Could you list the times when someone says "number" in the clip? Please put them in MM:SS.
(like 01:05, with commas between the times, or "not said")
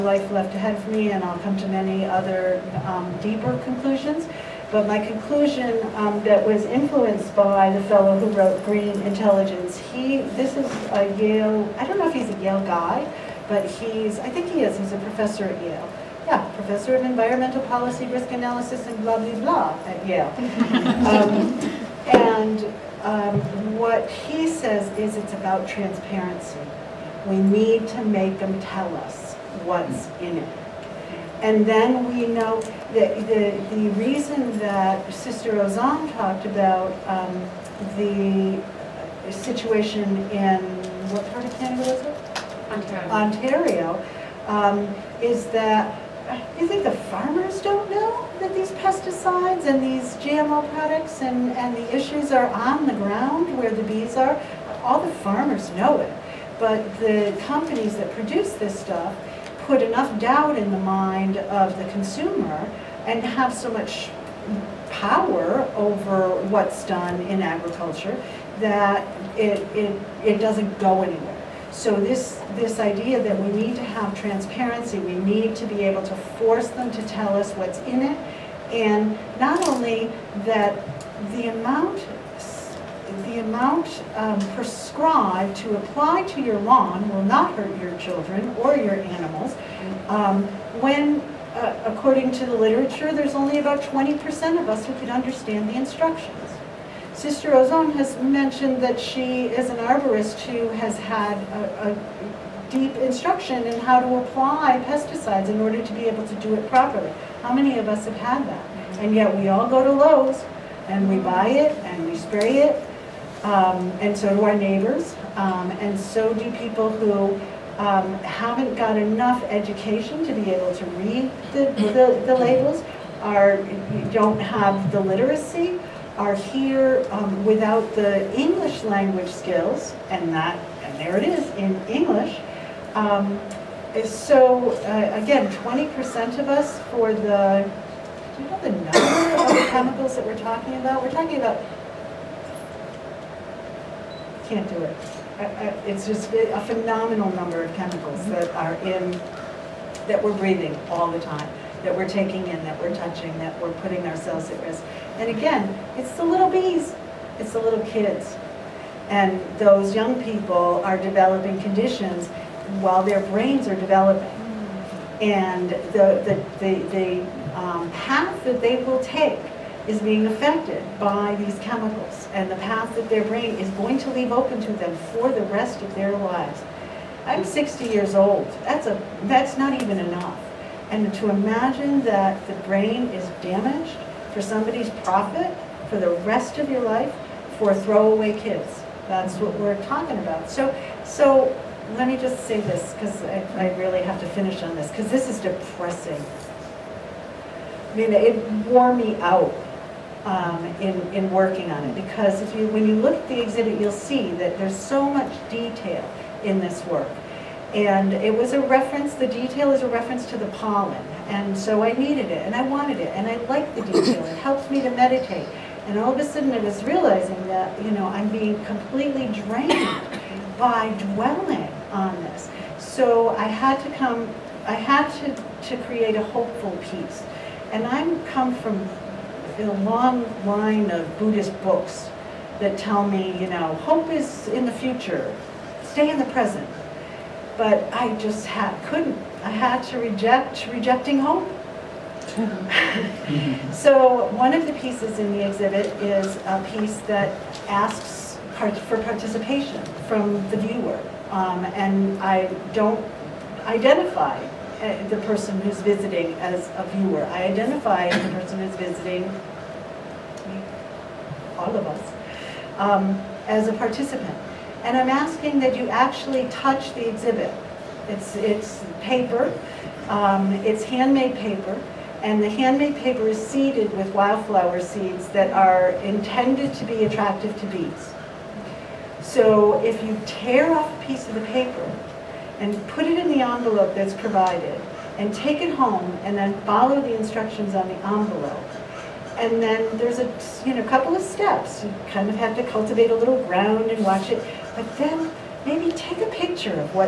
02:18, 02:27.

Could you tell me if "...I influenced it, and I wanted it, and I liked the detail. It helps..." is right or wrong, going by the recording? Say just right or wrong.
wrong.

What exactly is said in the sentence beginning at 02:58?
That's, a, that's not even enough.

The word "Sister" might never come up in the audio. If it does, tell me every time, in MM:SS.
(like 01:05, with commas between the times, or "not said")
00:35, 01:37.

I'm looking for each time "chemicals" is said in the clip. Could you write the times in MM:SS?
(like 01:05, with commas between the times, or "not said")
02:19, 02:27, 02:51.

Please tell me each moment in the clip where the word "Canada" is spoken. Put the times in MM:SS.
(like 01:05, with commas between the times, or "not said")
00:41.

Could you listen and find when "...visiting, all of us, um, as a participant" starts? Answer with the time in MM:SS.
04:18.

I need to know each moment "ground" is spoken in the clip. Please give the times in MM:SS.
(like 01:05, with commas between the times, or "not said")
00:52, 04:53.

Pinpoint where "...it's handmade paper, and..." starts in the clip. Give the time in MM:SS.
04:30.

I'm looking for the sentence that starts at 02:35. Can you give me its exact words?
And again, it's the little bees, it's the little kids.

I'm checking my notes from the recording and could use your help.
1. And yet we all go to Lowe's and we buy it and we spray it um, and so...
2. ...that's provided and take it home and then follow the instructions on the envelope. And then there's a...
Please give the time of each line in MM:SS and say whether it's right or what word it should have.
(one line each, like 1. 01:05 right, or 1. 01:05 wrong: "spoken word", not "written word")
1. 01:48 right
2. 04:43 right.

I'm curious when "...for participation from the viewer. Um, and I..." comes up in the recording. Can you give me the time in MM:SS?
04:08.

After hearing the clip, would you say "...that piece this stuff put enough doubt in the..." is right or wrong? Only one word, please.
wrong.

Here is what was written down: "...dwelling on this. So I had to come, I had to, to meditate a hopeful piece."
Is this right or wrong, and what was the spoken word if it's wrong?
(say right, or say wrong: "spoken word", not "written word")
wrong: "create", not "meditate".